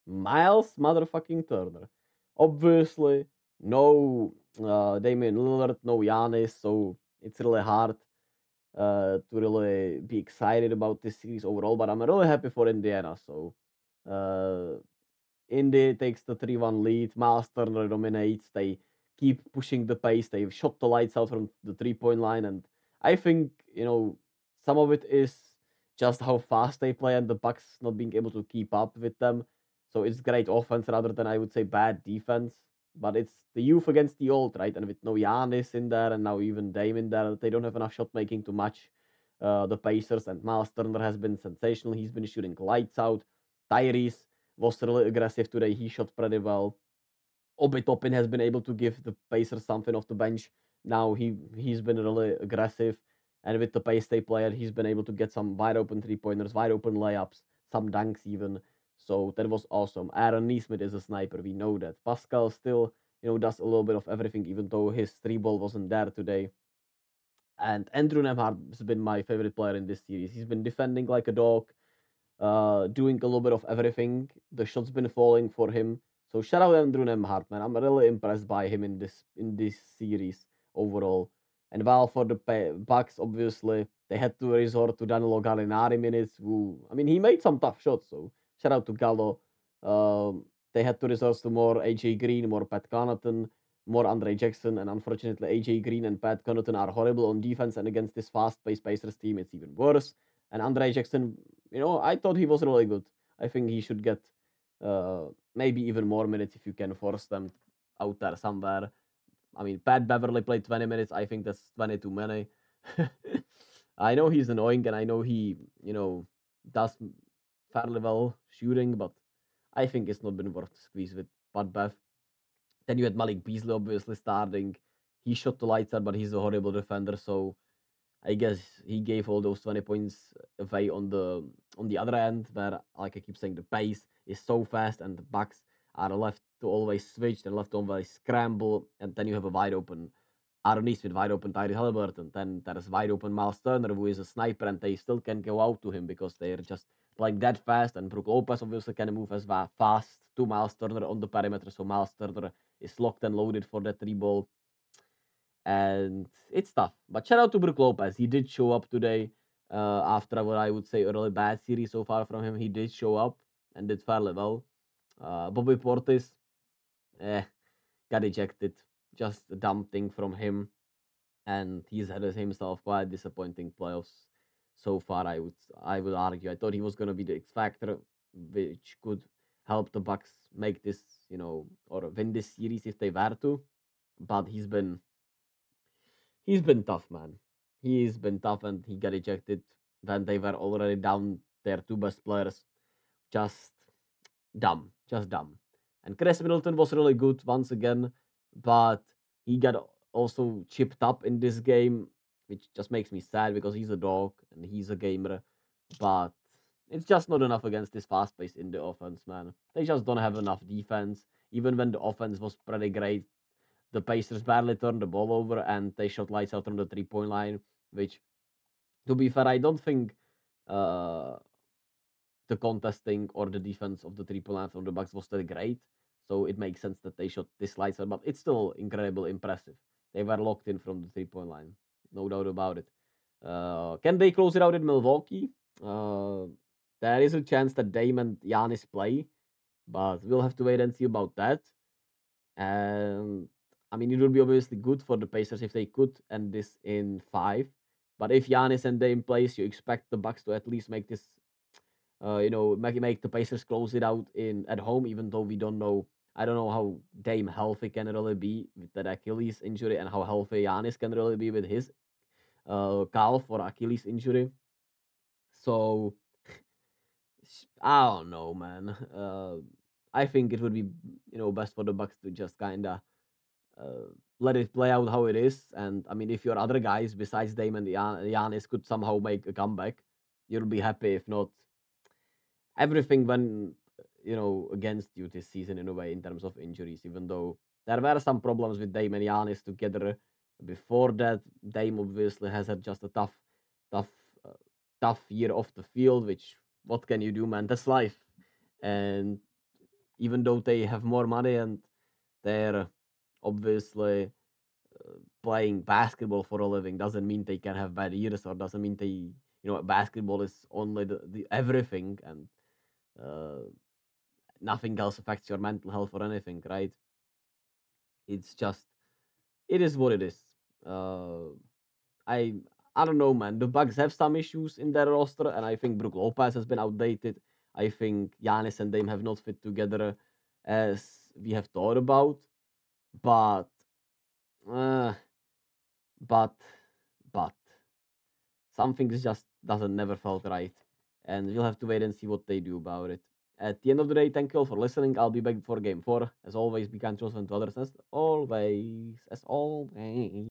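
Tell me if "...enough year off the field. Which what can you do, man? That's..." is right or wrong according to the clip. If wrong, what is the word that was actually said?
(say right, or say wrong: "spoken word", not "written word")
wrong: "tough", not "enough".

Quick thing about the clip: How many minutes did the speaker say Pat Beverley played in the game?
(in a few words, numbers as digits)
20.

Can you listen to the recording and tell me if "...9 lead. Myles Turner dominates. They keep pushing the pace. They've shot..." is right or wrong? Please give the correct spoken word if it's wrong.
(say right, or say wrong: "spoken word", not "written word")
wrong: "1", not "9".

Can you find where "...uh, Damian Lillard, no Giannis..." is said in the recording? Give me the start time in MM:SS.
00:04.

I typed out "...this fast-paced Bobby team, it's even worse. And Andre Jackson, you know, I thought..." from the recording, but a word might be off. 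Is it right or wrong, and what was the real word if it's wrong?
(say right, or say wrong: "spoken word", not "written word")
wrong: "Pacers", not "Bobby".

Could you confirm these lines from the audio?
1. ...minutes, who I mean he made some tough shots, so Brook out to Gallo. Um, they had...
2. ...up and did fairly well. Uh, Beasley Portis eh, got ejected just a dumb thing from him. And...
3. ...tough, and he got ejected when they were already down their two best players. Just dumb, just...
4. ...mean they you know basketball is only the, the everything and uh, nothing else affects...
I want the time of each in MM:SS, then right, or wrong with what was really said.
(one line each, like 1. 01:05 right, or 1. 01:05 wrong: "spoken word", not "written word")
1. 01:25 wrong: "Shout", not "Brook"
2. 02:43 wrong: "Bobby", not "Beasley"
3. 03:08 right
4. 05:08 right.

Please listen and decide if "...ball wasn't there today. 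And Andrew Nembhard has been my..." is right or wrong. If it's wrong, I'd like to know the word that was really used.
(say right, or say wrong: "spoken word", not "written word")
right.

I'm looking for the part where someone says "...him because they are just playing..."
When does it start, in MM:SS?
02:25.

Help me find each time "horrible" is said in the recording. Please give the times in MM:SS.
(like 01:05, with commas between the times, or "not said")
01:36, 02:06.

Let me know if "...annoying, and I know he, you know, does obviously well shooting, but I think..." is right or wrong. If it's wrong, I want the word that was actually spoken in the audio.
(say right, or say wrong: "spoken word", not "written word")
wrong: "fairly", not "obviously".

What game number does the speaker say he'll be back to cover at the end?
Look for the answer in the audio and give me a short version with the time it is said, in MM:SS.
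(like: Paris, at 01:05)
Game 4, at 05:45.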